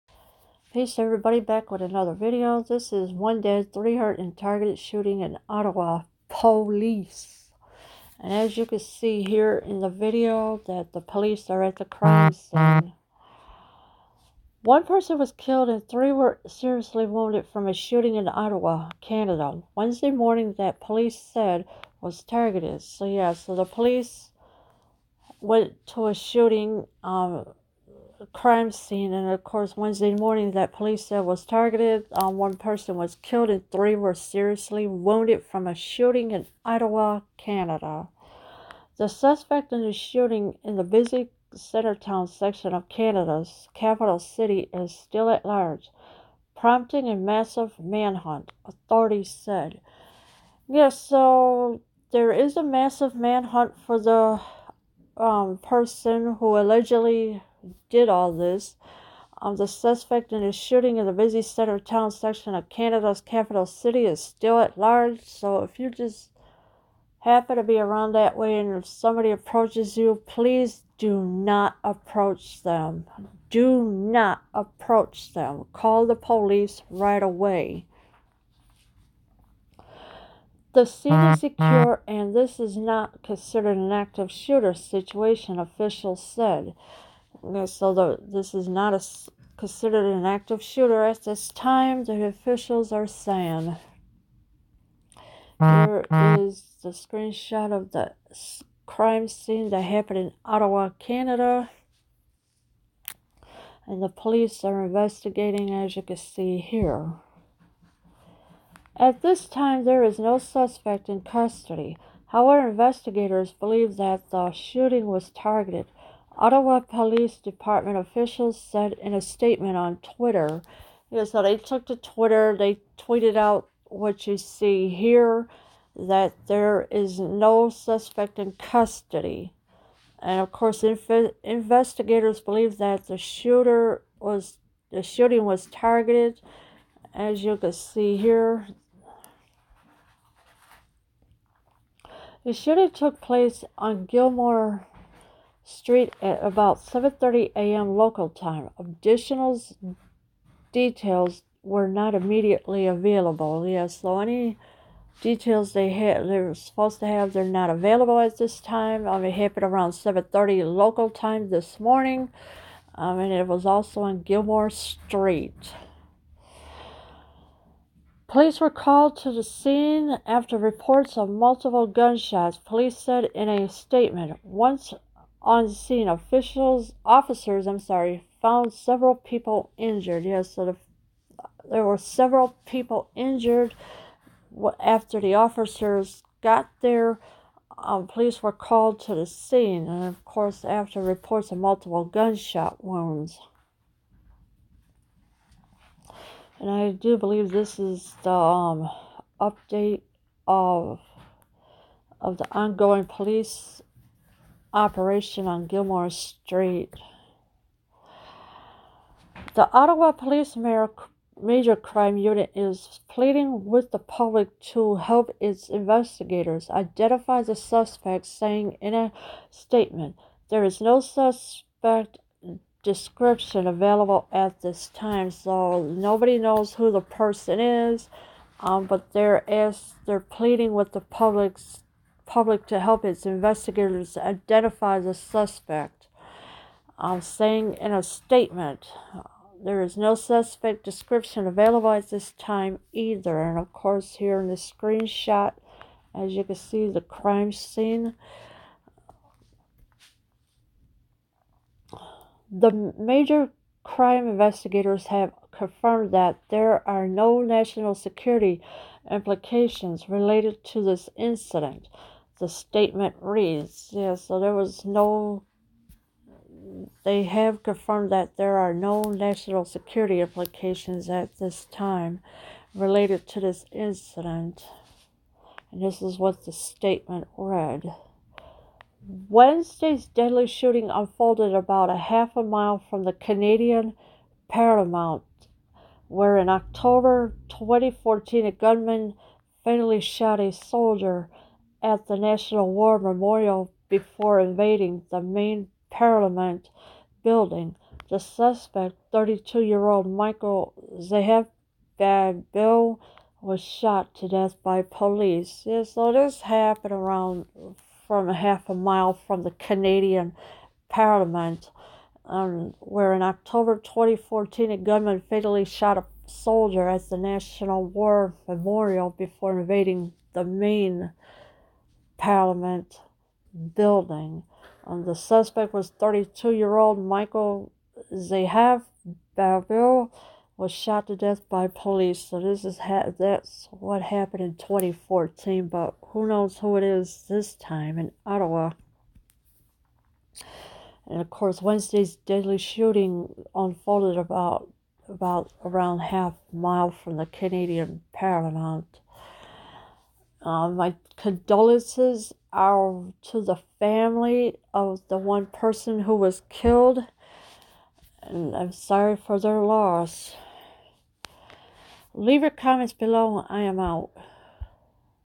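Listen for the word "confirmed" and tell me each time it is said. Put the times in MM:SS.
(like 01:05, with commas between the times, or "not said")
04:15, 04:27.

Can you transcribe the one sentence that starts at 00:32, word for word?
Um, one person was killed, and three were seriously wounded from a shooting in Ottawa, Canada.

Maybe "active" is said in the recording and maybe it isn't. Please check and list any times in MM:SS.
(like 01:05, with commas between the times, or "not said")
01:23, 01:30.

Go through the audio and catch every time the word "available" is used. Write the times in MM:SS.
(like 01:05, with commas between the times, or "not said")
02:32, 02:37, 03:43, 04:01.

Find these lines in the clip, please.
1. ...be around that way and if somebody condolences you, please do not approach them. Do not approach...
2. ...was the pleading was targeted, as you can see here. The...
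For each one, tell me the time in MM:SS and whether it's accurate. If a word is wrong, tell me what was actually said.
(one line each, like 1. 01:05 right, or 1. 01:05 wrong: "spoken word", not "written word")
1. 01:07 wrong: "approaches", not "condolences"
2. 02:14 wrong: "shooting", not "pleading".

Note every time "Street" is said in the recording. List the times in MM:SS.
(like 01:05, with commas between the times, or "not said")
02:25, 02:44, 03:26.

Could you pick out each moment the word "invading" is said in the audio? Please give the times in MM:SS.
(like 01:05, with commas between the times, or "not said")
04:54, 05:19.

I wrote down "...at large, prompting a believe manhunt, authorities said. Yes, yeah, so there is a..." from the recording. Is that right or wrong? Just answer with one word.
wrong.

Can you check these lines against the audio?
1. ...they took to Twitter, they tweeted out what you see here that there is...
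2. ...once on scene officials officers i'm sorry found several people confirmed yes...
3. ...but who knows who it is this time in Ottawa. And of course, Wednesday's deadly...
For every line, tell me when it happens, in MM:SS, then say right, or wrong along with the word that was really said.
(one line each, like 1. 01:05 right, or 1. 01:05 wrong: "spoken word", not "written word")
1. 02:01 right
2. 02:54 wrong: "injured", not "confirmed"
3. 05:35 right.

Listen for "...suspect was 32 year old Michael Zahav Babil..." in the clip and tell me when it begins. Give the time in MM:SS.
05:25.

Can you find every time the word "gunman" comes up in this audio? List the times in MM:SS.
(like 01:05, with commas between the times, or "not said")
04:48, 05:14.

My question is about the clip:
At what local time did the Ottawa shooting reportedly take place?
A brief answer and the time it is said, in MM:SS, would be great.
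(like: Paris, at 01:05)
7:30 a.m., at 02:26.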